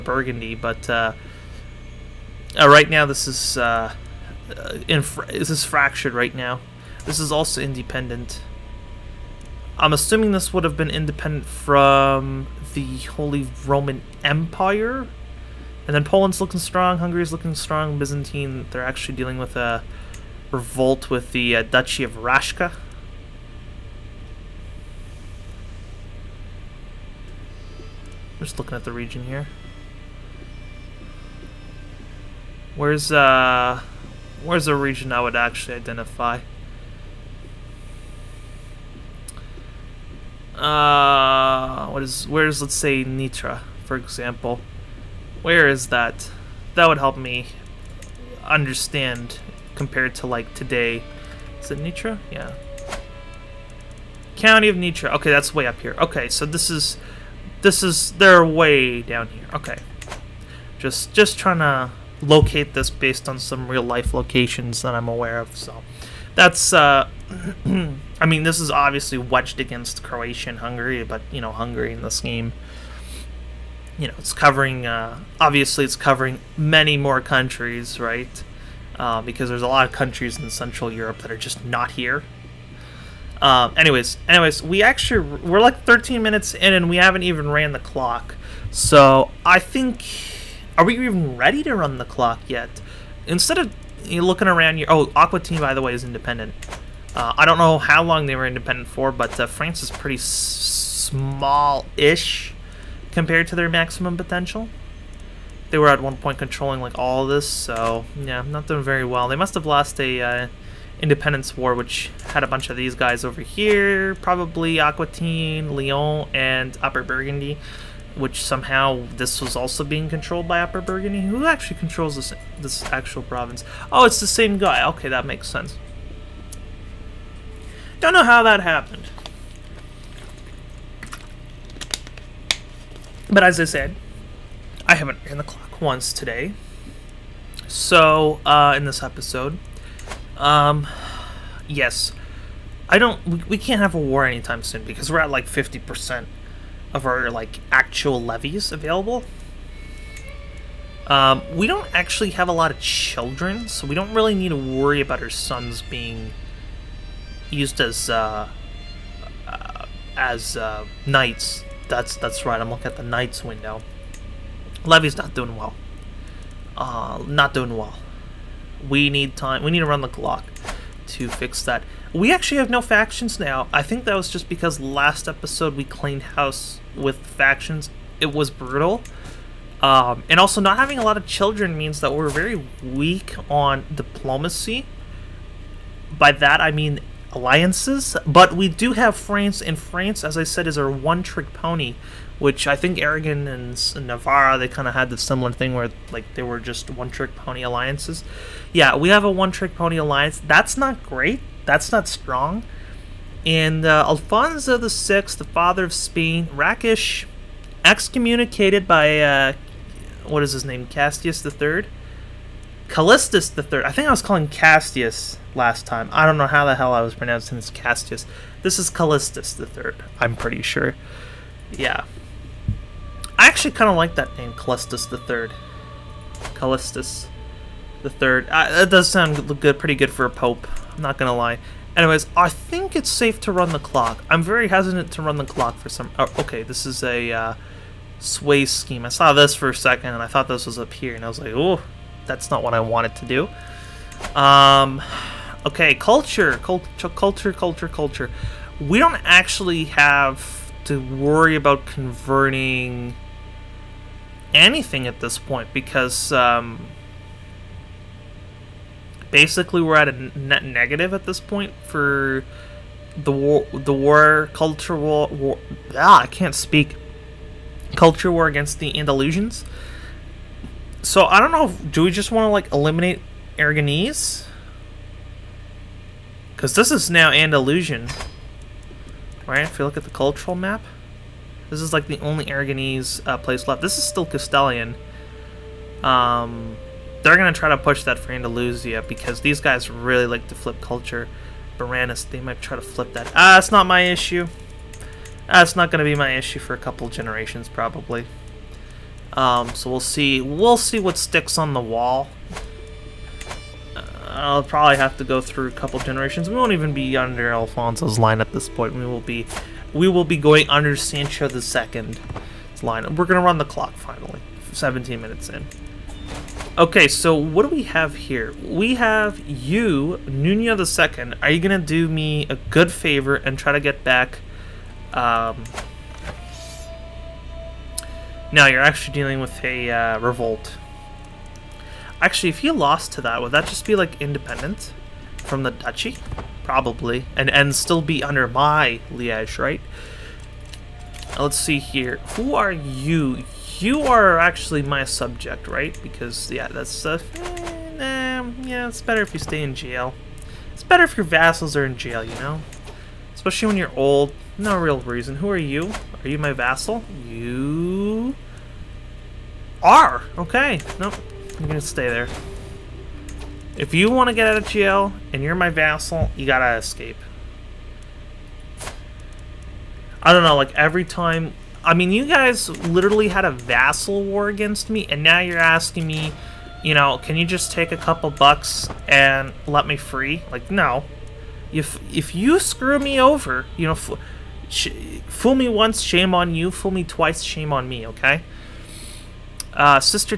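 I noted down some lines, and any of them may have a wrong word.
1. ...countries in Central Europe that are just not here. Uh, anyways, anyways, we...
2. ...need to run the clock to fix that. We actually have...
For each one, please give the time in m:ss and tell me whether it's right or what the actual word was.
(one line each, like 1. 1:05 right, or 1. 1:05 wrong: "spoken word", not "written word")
1. 1:19 right
2. 2:49 right.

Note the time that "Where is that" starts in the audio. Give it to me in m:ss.
0:45.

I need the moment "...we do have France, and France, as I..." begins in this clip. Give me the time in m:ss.
3:08.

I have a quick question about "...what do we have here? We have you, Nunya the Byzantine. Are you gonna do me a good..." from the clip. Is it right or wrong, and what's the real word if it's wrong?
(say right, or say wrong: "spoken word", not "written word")
wrong: "Second", not "Byzantine".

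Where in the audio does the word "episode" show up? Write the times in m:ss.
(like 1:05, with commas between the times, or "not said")
2:19, 2:55.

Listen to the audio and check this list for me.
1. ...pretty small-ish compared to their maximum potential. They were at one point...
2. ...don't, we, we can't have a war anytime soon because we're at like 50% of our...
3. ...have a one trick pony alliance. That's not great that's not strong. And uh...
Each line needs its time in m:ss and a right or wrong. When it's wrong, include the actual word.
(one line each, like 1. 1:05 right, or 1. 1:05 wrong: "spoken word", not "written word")
1. 1:39 right
2. 2:22 right
3. 3:19 right.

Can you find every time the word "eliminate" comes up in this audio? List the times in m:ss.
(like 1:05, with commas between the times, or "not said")
4:32.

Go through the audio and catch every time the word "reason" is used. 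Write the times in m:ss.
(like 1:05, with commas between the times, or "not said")
5:55.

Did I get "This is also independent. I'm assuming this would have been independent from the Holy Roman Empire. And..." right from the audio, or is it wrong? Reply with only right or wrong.
right.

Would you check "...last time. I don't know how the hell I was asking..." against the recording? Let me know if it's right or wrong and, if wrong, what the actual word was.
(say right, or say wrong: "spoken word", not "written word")
wrong: "pronouncing", not "asking".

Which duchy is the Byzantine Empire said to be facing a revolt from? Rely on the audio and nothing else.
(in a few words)
Duchy of Rashka.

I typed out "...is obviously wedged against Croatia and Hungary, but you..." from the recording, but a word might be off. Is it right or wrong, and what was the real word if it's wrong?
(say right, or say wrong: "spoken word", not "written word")
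right.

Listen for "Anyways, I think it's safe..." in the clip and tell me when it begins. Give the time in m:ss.
3:51.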